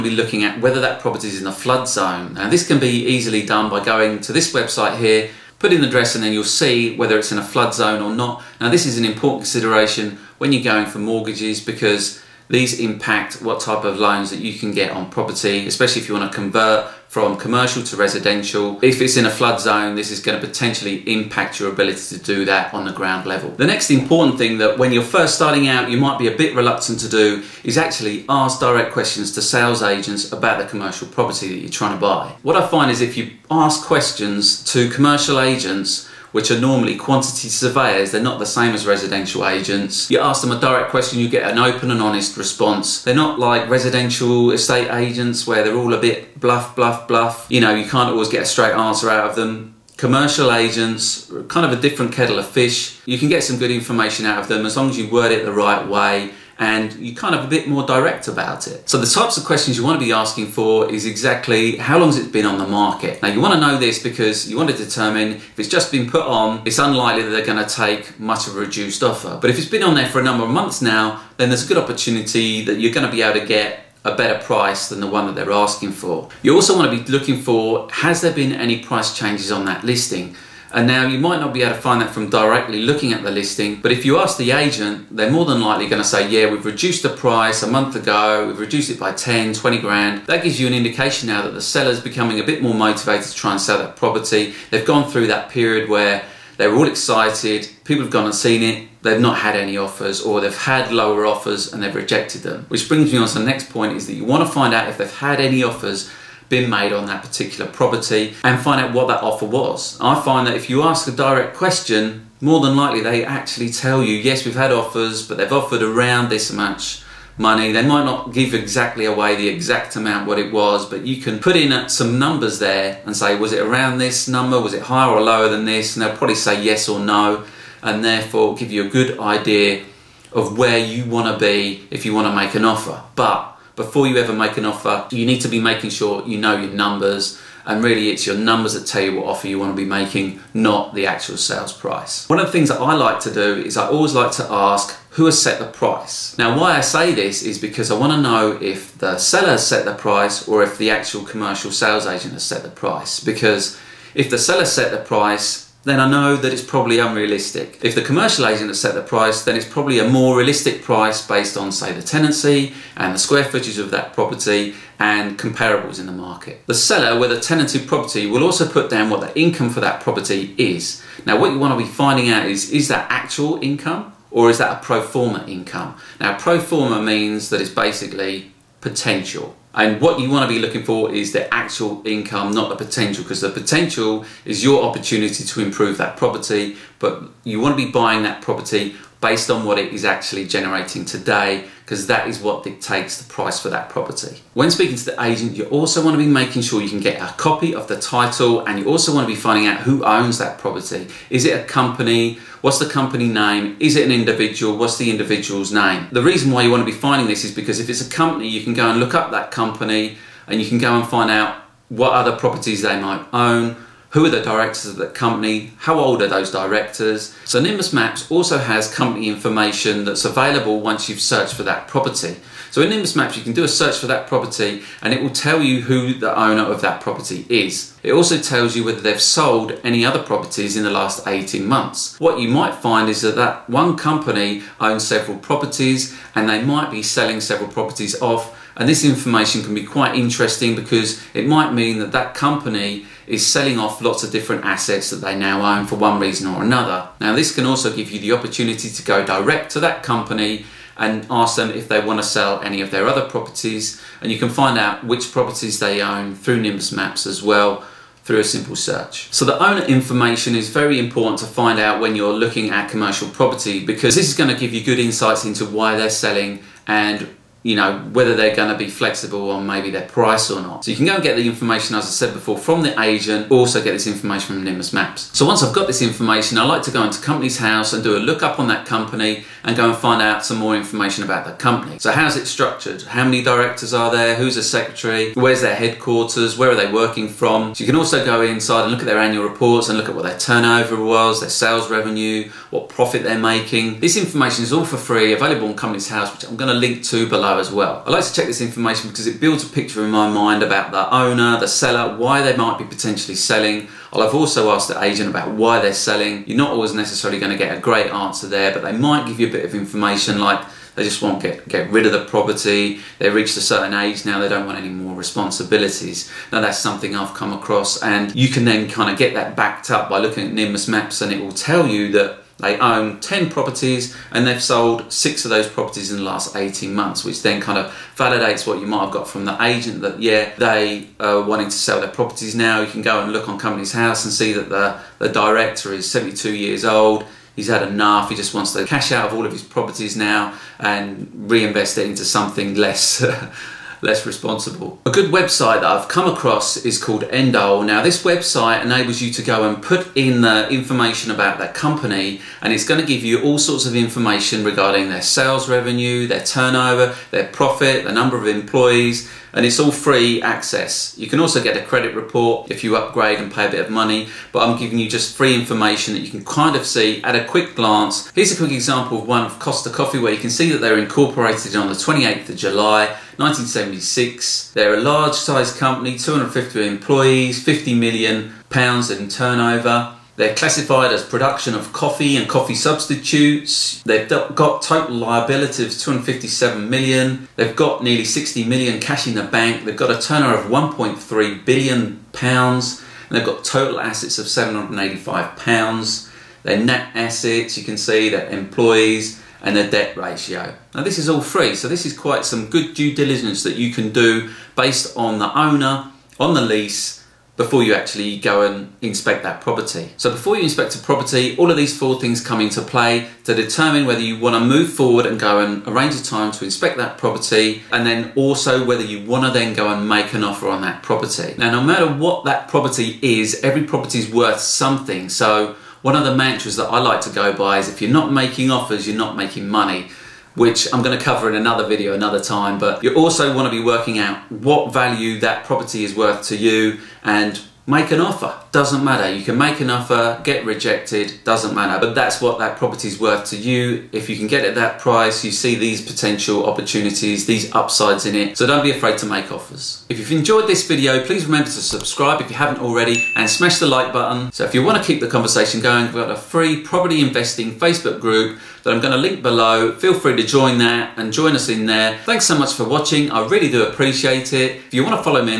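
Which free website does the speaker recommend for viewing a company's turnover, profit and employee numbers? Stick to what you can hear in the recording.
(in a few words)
Endole.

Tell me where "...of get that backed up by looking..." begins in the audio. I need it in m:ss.
5:19.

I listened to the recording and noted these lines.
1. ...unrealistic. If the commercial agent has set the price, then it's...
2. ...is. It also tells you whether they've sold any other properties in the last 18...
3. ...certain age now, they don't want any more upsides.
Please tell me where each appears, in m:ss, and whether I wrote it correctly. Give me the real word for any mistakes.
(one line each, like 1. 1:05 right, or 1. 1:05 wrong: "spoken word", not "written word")
1. 2:36 right
2. 3:47 right
3. 5:13 wrong: "responsibilities", not "upsides".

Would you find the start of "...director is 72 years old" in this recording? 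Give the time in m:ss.
5:35.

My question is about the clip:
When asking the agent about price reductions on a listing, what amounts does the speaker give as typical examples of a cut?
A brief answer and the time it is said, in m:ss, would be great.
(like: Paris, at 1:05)
10, 20 grand, at 1:29.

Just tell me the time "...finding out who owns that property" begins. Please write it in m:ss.
3:19.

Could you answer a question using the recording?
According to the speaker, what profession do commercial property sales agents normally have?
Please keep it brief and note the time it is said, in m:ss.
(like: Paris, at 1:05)
Quantity surveyors, at 0:36.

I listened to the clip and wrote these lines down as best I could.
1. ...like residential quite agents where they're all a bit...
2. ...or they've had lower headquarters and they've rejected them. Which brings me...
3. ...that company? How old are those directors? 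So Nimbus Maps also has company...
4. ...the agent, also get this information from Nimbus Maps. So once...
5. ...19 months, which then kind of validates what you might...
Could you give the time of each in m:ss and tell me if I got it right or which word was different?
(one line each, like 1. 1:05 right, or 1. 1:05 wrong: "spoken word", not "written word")
1. 0:43 wrong: "estate", not "quite"
2. 1:40 wrong: "offers", not "headquarters"
3. 3:34 right
4. 4:32 right
5. 5:26 wrong: "18", not "19".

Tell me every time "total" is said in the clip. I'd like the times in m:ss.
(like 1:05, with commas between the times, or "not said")
6:24, 6:33.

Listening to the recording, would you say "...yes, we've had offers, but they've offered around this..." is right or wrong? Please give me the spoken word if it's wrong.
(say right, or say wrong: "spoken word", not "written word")
right.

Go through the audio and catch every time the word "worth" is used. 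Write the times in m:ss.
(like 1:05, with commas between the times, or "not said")
7:04, 7:16, 7:23.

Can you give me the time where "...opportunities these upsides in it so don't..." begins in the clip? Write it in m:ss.
7:26.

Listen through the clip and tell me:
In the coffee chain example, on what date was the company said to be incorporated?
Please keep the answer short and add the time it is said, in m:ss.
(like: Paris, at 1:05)
28 July 1976, at 6:11.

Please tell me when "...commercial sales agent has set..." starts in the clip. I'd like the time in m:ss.
2:31.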